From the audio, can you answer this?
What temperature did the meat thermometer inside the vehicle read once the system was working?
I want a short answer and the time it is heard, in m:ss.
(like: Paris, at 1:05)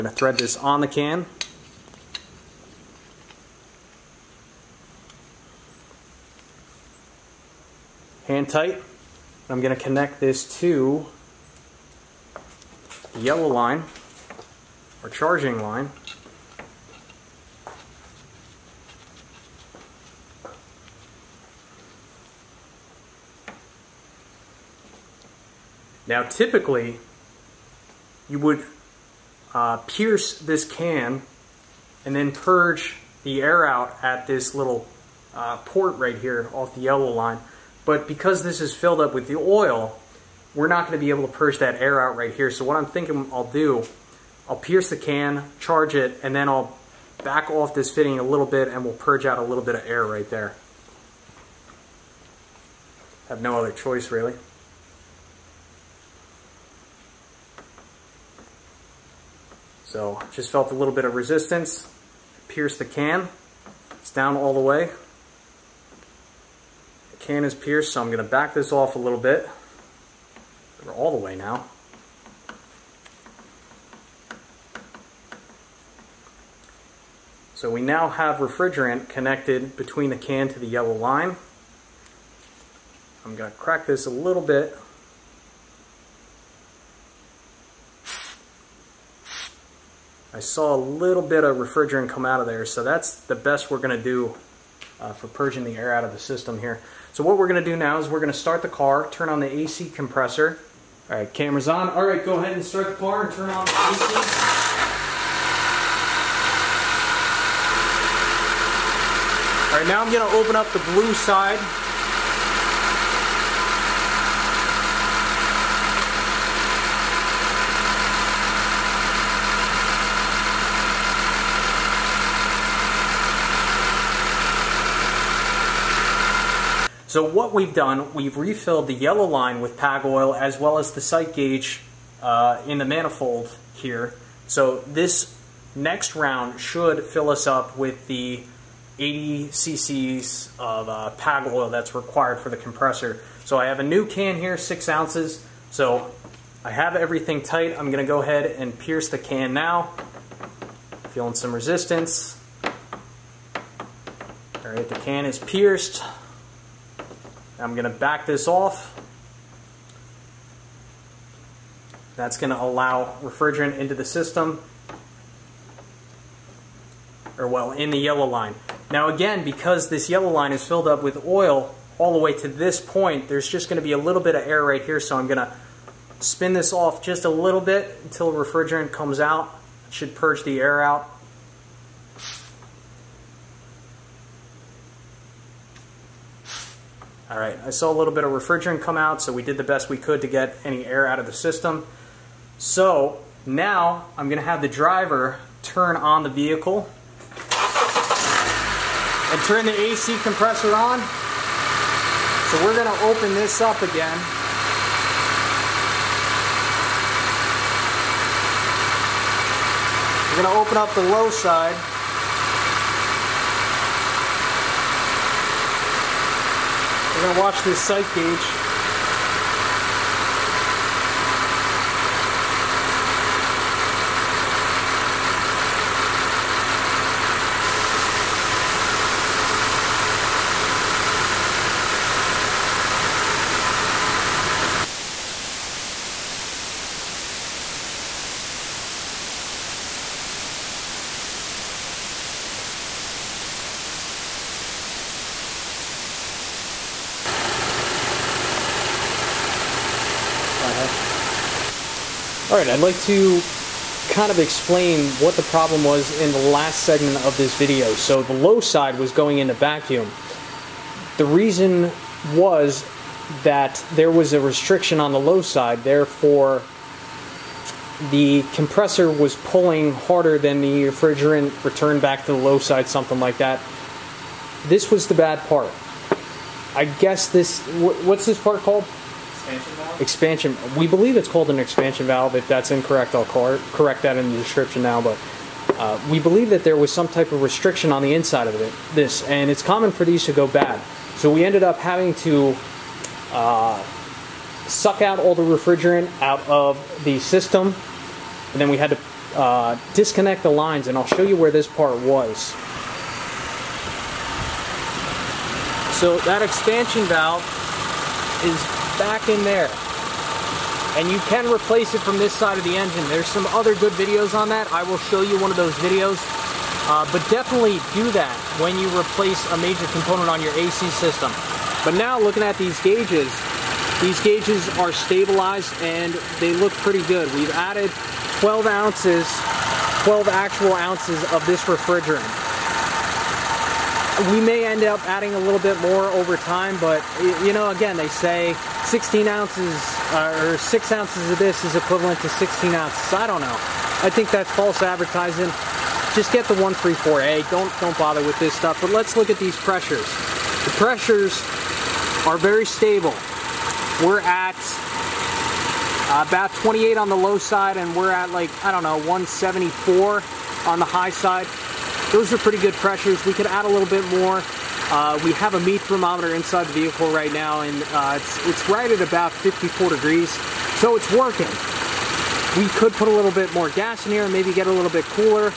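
54 degrees, at 6:09.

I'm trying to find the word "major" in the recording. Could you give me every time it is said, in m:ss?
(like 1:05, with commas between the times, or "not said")
5:19.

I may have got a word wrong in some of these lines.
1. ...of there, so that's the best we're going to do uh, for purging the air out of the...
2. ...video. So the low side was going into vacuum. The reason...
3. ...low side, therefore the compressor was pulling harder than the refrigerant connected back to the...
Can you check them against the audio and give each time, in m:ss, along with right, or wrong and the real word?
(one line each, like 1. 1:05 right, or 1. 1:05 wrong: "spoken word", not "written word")
1. 1:32 right
2. 4:17 right
3. 4:25 wrong: "returned", not "connected".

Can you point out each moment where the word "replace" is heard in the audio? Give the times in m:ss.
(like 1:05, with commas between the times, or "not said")
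5:11, 5:18.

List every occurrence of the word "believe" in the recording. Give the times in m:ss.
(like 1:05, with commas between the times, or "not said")
4:40, 4:46.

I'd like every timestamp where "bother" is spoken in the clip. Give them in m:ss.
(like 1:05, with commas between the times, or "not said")
5:47.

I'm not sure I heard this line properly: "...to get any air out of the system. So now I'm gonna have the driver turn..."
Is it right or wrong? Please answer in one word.
right.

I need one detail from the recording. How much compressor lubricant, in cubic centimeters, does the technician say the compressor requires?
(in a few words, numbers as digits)
80 cc.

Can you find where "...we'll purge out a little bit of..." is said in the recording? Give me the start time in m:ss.
0:48.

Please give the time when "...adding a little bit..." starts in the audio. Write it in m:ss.
5:35.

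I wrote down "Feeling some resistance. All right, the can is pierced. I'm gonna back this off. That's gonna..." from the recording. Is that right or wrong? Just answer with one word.
right.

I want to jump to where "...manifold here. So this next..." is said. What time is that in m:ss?
2:12.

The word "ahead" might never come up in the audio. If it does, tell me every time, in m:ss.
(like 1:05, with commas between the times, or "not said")
1:42, 2:28.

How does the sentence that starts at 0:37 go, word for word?
But because this is filled up with the oil, we're not going to be able to purge that air out right here.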